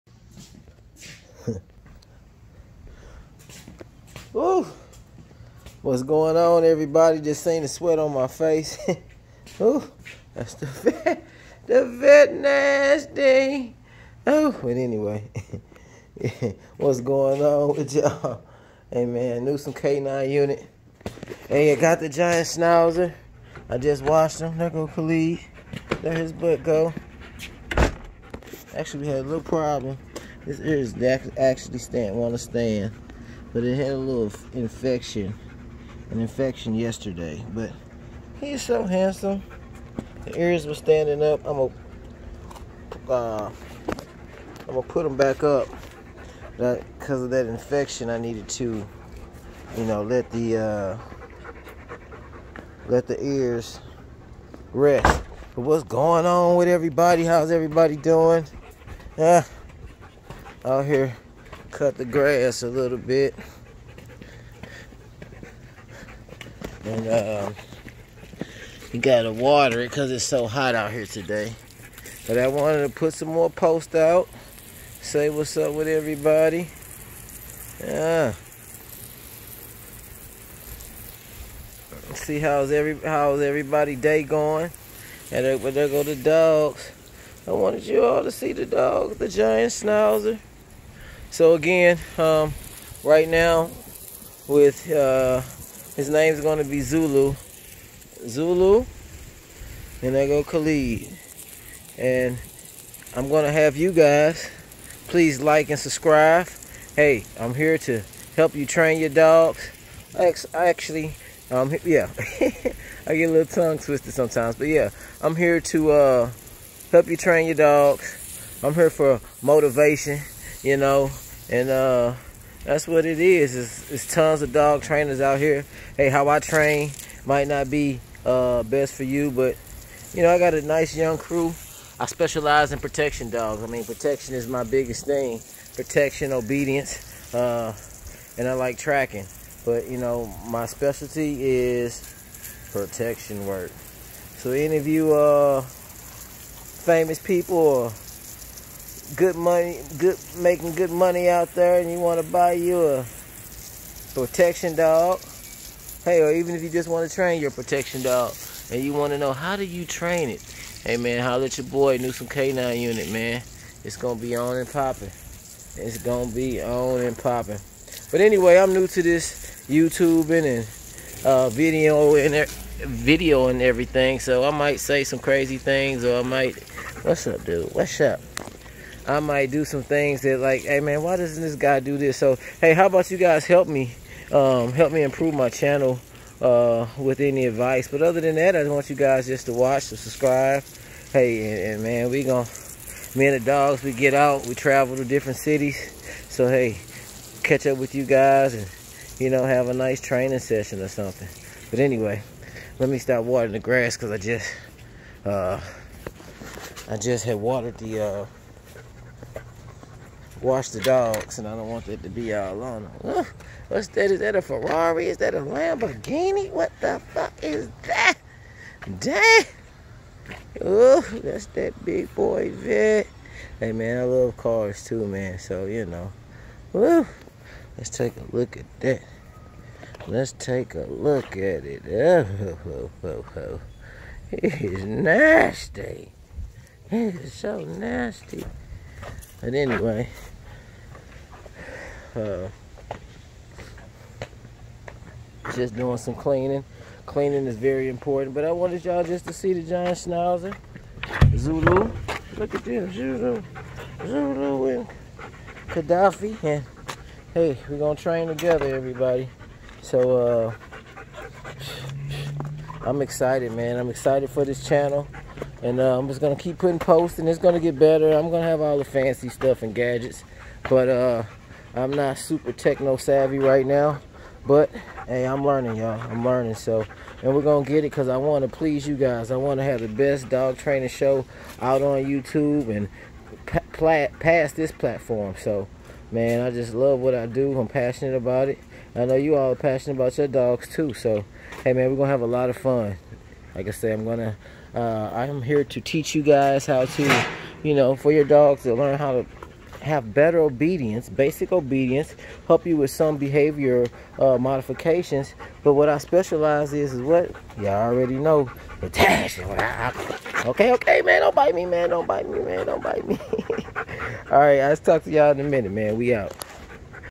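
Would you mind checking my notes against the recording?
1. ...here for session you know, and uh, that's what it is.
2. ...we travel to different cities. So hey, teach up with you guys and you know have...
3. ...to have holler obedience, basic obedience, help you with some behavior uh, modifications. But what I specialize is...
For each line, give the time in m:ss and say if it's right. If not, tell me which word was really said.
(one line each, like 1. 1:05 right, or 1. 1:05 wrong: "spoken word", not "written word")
1. 1:58 wrong: "motivation", not "session"
2. 3:14 wrong: "catch", not "teach"
3. 4:59 wrong: "better", not "holler".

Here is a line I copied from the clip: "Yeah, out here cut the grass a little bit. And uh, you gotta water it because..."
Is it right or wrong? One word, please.
right.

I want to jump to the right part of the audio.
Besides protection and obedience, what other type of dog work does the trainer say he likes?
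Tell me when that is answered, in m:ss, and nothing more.
2:18.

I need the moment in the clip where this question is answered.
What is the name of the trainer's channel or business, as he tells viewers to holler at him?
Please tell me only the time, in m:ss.
2:41.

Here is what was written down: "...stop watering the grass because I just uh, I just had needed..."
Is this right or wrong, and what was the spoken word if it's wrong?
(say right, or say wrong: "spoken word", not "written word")
wrong: "watered", not "needed".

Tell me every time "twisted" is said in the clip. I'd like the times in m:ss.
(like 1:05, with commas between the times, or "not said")
1:53.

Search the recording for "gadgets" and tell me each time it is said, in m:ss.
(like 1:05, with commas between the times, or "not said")
4:29.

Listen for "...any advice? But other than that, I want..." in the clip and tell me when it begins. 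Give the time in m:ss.
3:07.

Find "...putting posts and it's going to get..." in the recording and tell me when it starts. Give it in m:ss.
4:26.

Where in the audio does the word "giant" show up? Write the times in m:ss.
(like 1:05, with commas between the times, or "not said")
0:22, 1:29, 4:09.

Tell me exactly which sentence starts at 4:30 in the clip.
But uh, I'm not super techno savvy right now.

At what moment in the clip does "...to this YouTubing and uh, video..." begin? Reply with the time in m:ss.
2:48.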